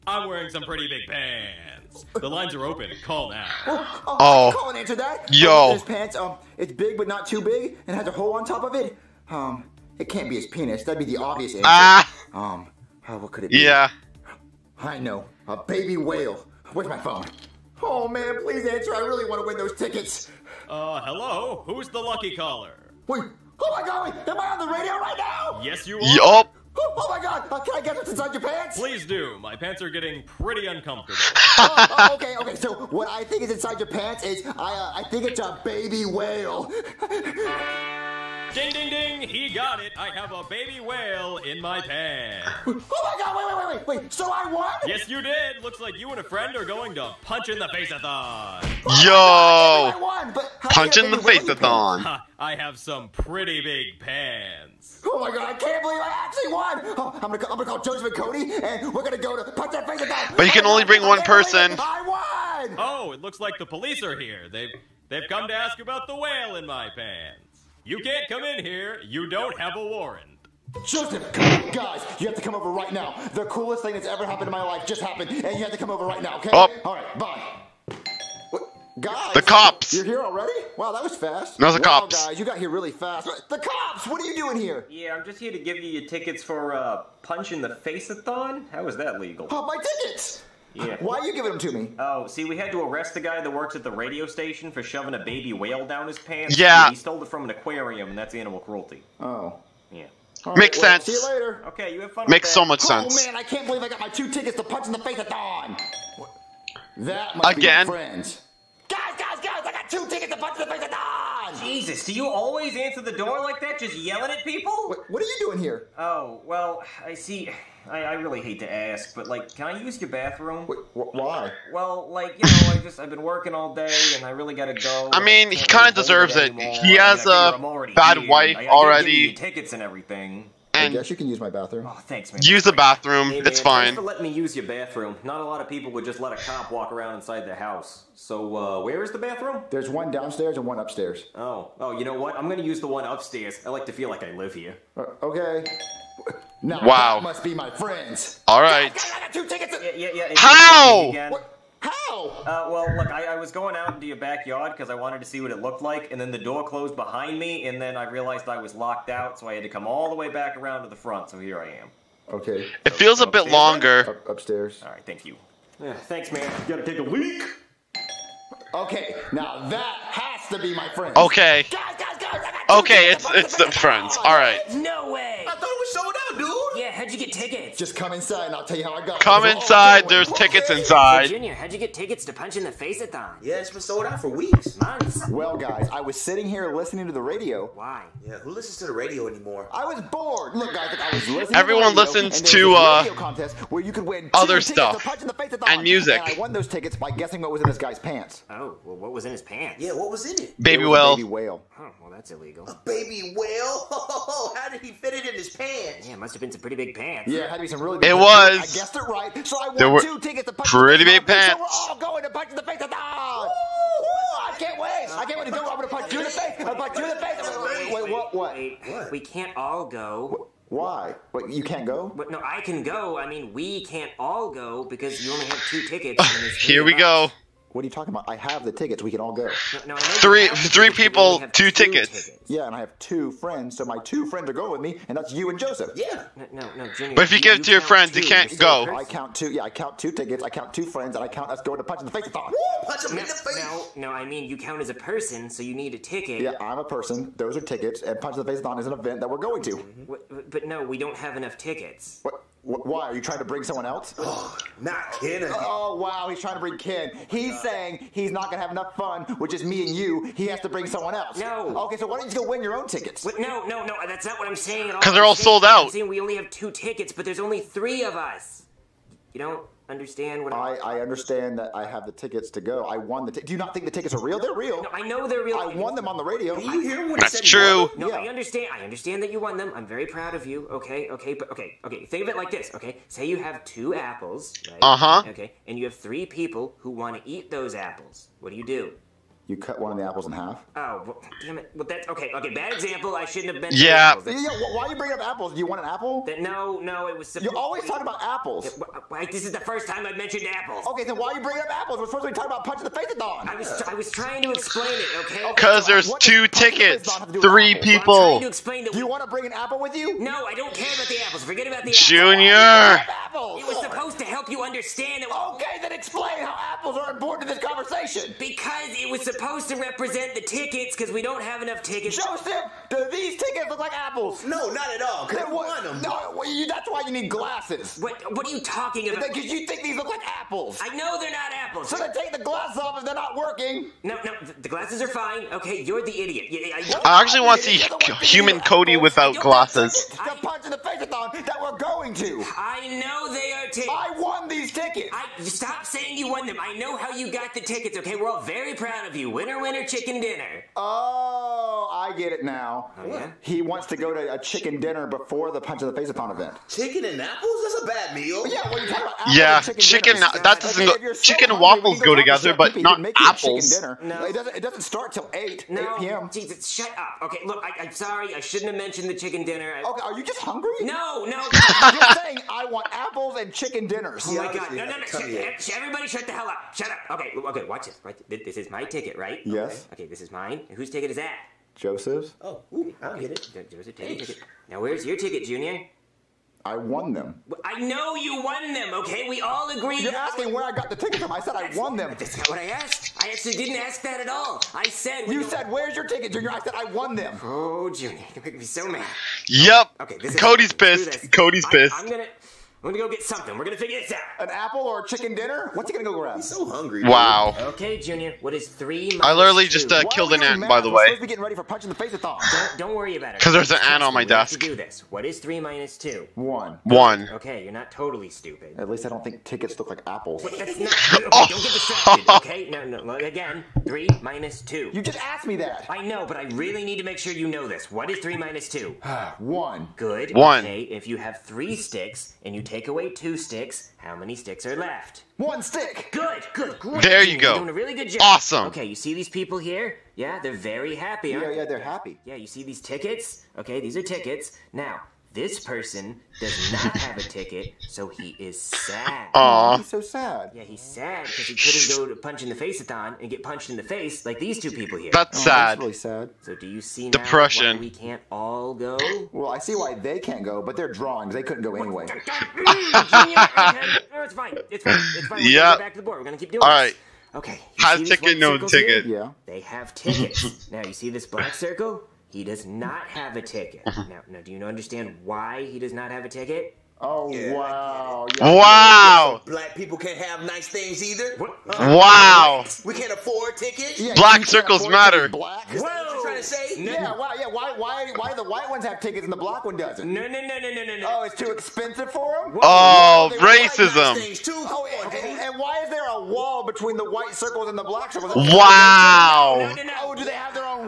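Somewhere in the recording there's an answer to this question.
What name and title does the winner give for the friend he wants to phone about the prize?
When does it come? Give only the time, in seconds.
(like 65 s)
57 s.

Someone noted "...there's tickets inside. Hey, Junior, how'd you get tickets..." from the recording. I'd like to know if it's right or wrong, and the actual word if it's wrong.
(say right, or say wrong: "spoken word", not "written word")
right.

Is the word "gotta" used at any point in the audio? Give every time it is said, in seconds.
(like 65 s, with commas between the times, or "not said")
124 s, 166 s.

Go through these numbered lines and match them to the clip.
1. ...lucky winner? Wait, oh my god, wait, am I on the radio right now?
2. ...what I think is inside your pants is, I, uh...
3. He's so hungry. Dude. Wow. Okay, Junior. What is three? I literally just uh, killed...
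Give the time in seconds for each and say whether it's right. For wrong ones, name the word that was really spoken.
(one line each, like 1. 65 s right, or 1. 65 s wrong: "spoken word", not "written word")
1. 21 s wrong: "caller", not "winner"
2. 32 s right
3. 406 s right.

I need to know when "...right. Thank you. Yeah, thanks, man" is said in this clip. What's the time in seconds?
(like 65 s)
164 s.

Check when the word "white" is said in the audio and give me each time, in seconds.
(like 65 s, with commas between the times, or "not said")
488 s, 497 s.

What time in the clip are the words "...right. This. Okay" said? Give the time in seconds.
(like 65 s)
466 s.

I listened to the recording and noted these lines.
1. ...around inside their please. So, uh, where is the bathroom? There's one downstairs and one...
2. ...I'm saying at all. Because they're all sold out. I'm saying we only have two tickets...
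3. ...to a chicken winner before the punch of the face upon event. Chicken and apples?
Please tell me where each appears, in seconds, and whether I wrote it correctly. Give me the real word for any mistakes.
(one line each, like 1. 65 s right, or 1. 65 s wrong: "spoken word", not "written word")
1. 136 s wrong: "house", not "please"
2. 264 s right
3. 354 s wrong: "dinner", not "winner".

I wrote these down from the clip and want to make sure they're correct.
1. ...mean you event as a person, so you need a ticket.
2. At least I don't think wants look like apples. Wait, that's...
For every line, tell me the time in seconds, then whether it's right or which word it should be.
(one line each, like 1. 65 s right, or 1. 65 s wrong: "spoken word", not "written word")
1. 244 s wrong: "count", not "event"
2. 418 s wrong: "tickets", not "wants".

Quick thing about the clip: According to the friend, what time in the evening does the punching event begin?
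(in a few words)
8 p.m.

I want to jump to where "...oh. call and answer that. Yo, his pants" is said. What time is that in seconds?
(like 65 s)
4 s.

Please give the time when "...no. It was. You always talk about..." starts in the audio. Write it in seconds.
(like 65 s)
296 s.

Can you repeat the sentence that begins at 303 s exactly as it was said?
I was, I was trying to explain it.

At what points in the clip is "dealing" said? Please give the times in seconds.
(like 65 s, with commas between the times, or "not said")
not said.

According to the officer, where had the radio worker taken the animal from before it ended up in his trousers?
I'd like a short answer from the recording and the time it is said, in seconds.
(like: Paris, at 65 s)
An aquarium, at 97 s.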